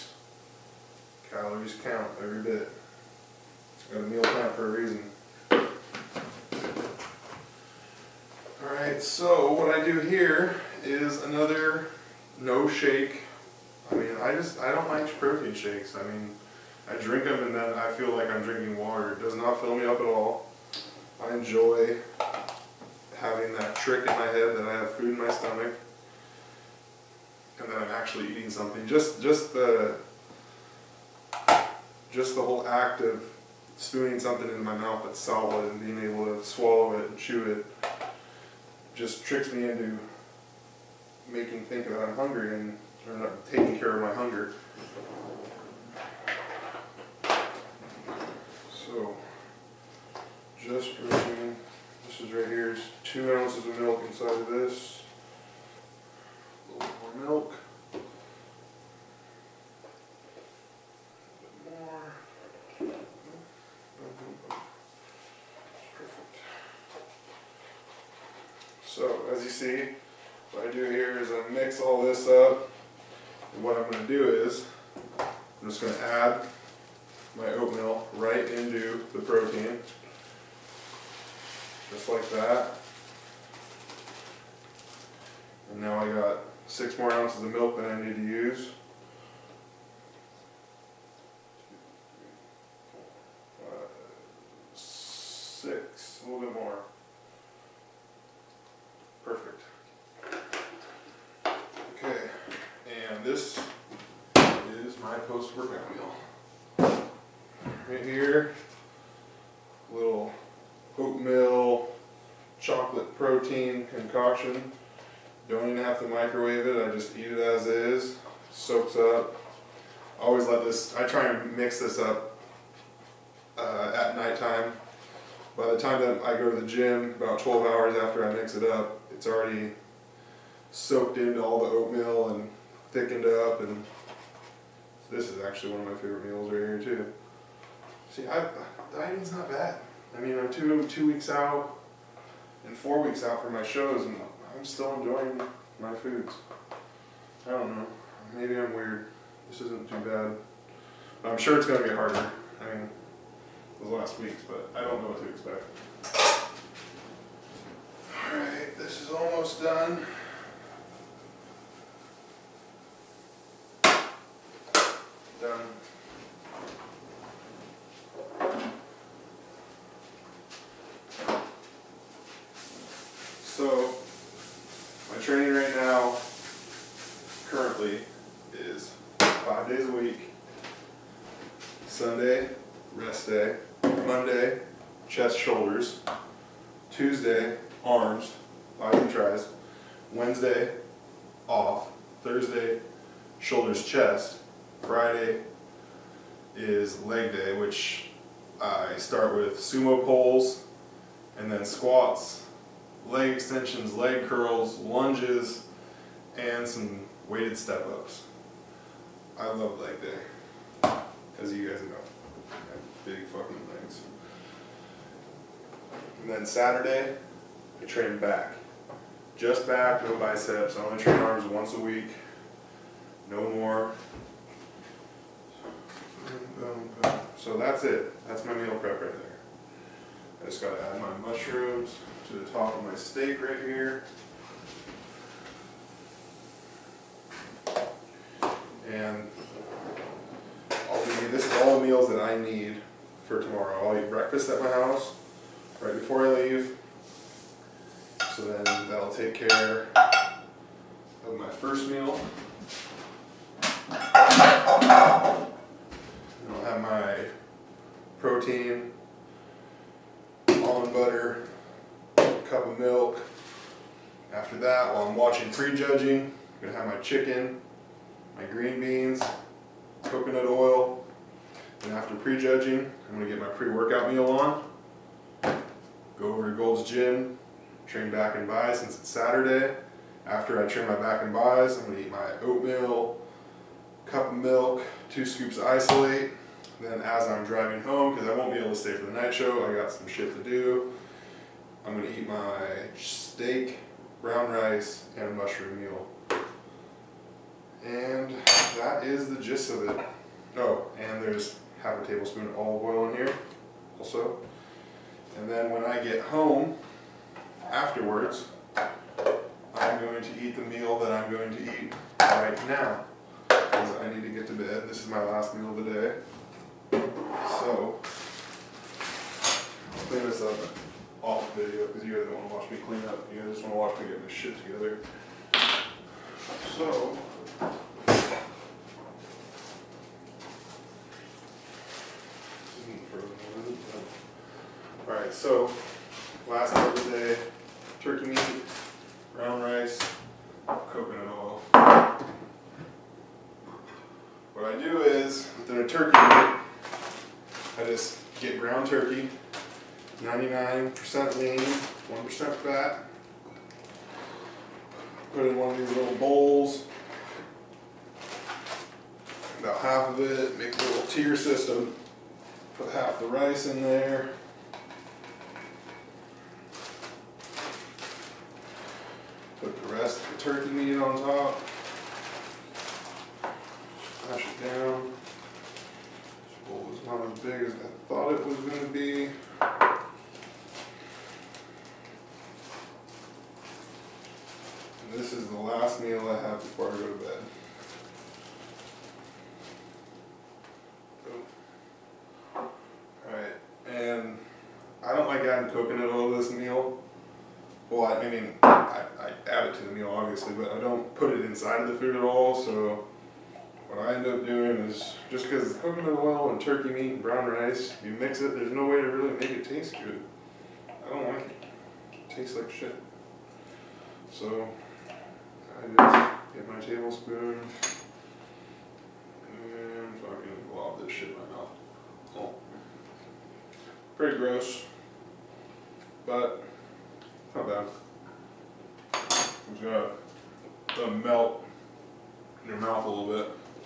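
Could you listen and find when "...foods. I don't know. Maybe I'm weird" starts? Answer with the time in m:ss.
2:25.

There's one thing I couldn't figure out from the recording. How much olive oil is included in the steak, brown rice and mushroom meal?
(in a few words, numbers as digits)
Half a tablespoon.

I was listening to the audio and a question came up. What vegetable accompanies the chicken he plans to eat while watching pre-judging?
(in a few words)
Green beans.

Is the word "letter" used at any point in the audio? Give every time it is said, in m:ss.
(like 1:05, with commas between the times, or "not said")
not said.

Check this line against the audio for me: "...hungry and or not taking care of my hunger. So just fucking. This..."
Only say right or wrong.
wrong.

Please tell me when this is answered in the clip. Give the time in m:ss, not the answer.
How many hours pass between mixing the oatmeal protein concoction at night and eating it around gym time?
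2:07.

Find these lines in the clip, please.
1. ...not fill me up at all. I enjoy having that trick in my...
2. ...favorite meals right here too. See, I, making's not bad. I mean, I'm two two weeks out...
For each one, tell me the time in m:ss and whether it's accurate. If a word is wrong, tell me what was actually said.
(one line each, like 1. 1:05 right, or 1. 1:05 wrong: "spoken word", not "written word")
1. 0:19 right
2. 2:15 wrong: "dieting", not "making".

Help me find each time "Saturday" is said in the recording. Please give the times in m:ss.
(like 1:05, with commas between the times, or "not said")
3:36, 4:39.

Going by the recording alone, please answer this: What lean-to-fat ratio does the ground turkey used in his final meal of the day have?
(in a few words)
99% lean.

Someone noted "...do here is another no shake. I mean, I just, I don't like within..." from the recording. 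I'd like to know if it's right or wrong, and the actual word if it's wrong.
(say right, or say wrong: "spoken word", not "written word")
wrong: "protein", not "within".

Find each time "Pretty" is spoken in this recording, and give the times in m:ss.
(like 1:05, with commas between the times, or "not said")
7:04.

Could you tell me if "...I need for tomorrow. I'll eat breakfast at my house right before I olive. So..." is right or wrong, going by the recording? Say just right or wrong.
wrong.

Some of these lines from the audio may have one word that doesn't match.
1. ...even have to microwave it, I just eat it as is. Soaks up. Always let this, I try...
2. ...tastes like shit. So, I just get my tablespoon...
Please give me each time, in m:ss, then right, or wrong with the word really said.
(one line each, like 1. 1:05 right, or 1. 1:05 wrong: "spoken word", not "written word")
1. 1:55 right
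2. 6:52 right.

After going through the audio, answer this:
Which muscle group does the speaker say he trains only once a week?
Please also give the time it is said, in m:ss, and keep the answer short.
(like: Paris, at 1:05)
Arms, at 3:41.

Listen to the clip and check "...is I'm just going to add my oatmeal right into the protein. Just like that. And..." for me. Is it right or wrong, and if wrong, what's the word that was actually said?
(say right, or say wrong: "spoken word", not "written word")
right.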